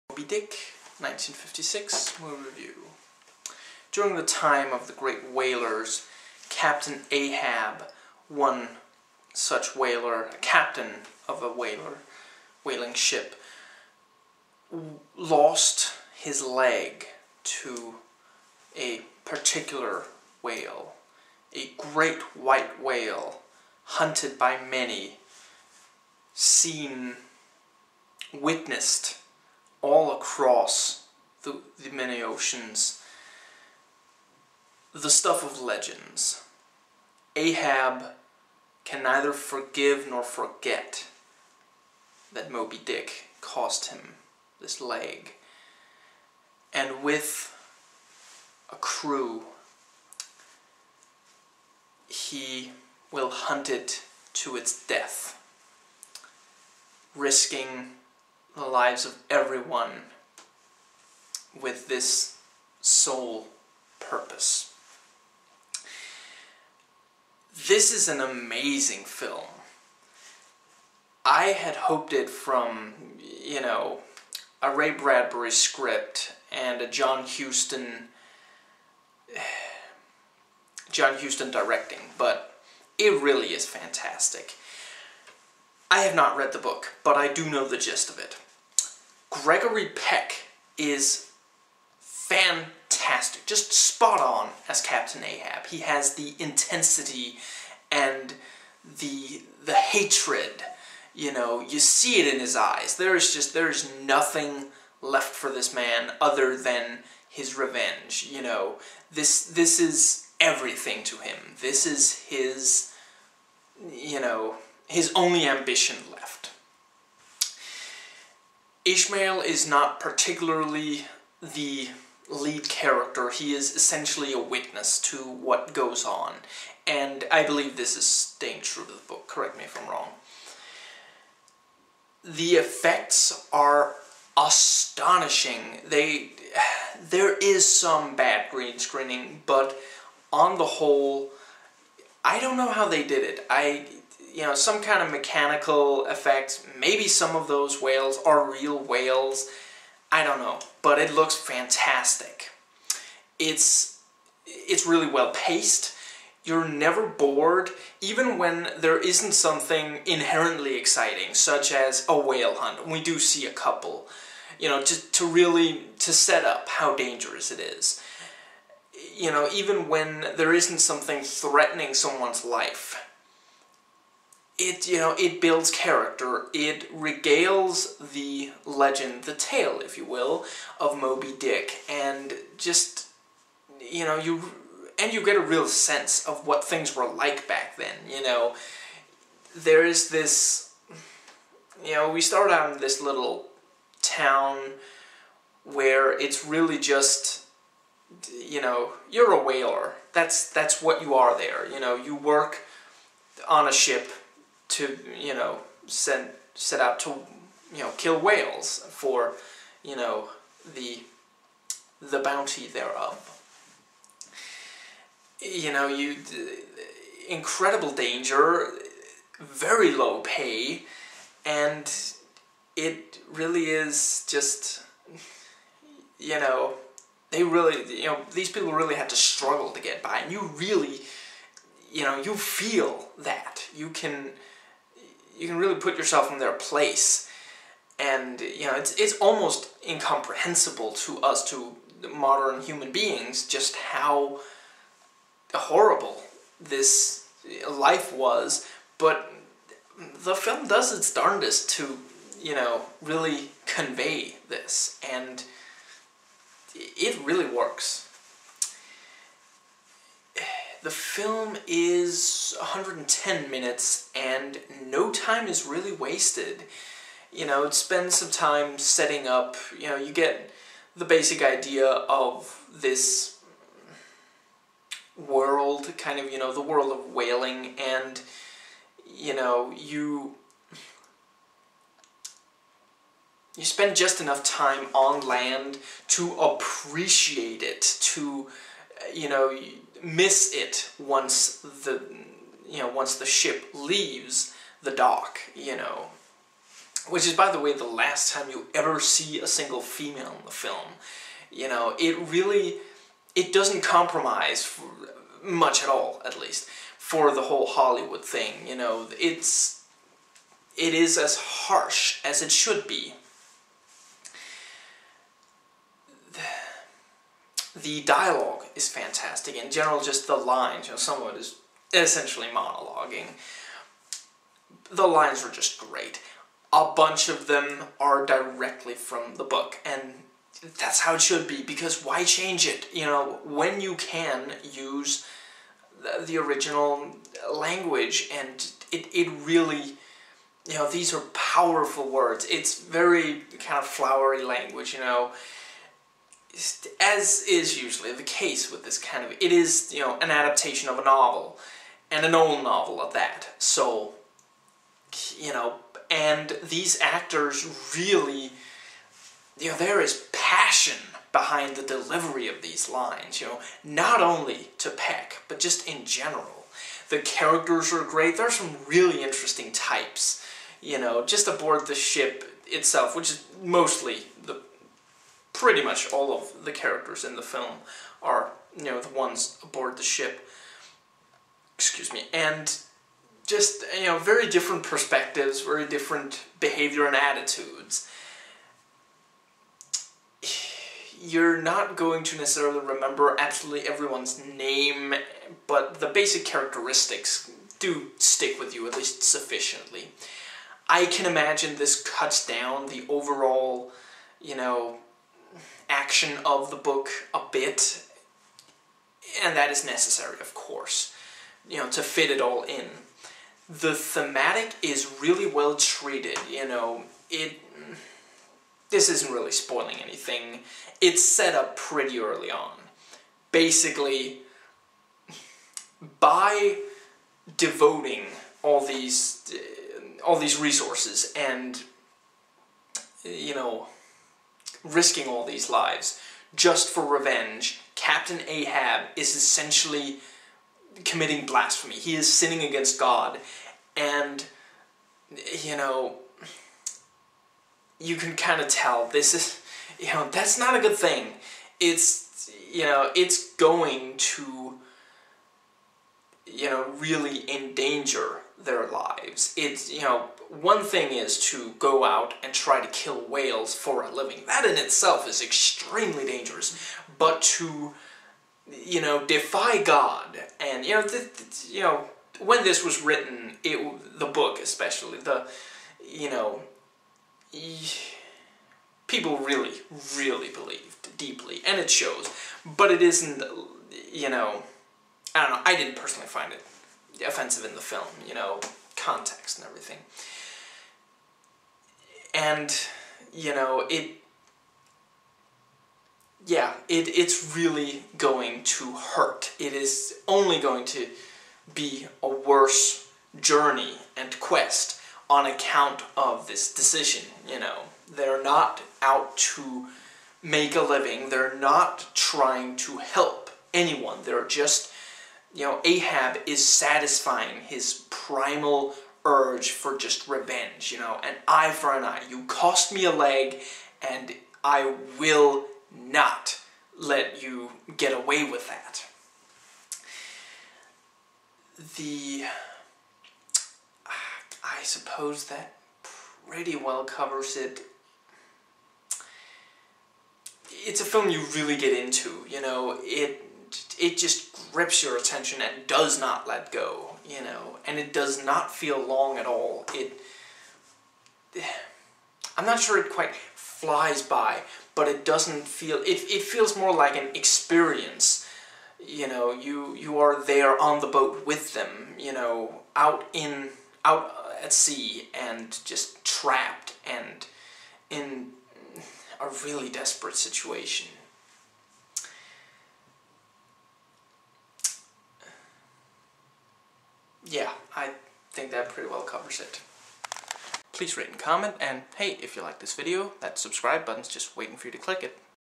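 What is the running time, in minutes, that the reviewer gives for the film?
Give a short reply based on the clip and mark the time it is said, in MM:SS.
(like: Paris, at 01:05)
110, at 04:22.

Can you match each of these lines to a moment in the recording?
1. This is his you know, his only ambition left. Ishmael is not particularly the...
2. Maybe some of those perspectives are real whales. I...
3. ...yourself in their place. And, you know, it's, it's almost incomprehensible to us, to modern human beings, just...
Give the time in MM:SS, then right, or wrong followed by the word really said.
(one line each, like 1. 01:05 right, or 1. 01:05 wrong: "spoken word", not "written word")
1. 01:51 right
2. 02:26 wrong: "whales", not "perspectives"
3. 03:55 right.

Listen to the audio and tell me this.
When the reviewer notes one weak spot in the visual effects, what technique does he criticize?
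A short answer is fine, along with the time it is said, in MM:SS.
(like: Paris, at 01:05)
green screening, at 02:18.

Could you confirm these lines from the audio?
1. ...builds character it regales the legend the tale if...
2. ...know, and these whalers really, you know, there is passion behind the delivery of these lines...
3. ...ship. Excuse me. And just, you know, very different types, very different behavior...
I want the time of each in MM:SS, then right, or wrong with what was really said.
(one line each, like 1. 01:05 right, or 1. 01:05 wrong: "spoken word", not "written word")
1. 02:55 right
2. 05:55 wrong: "actors", not "whalers"
3. 06:20 wrong: "perspectives", not "types".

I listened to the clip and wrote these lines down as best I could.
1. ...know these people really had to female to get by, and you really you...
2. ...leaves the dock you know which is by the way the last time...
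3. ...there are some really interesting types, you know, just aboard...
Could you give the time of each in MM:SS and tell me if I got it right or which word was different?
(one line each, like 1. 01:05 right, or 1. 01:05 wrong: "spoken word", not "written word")
1. 03:48 wrong: "struggle", not "female"
2. 04:53 right
3. 06:08 right.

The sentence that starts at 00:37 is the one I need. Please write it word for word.
Ahab can neither forgive nor forget that Moby Dick cost him this leg.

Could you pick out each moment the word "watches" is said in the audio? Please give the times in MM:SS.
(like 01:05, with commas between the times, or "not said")
not said.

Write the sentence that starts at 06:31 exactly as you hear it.
You're not going to necessarily remember absolutely everyone's name, but the basic characteristics do stick with you, at least sufficiently.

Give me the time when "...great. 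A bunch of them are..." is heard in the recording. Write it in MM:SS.
05:25.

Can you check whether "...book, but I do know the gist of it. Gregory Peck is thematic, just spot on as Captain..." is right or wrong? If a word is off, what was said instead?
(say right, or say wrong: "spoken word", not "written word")
wrong: "fantastic", not "thematic".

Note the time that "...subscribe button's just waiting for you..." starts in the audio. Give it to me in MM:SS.
09:43.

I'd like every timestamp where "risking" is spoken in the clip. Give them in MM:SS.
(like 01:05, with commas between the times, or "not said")
00:57, 07:14.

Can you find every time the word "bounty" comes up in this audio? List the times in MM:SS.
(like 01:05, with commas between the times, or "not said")
03:32.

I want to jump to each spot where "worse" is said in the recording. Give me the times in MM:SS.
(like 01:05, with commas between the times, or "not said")
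08:22.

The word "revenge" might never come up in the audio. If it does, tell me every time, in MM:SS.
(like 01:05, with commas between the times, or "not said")
01:47, 07:17, 08:40.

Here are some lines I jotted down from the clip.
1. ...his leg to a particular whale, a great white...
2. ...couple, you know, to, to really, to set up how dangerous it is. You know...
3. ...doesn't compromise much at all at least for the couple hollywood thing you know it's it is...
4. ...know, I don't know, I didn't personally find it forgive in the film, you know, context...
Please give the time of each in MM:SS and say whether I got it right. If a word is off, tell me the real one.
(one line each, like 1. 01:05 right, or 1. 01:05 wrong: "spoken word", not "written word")
1. 00:16 right
2. 02:43 right
3. 05:03 wrong: "whole", not "couple"
4. 08:04 wrong: "offensive", not "forgive".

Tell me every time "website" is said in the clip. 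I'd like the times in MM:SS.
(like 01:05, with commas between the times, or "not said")
not said.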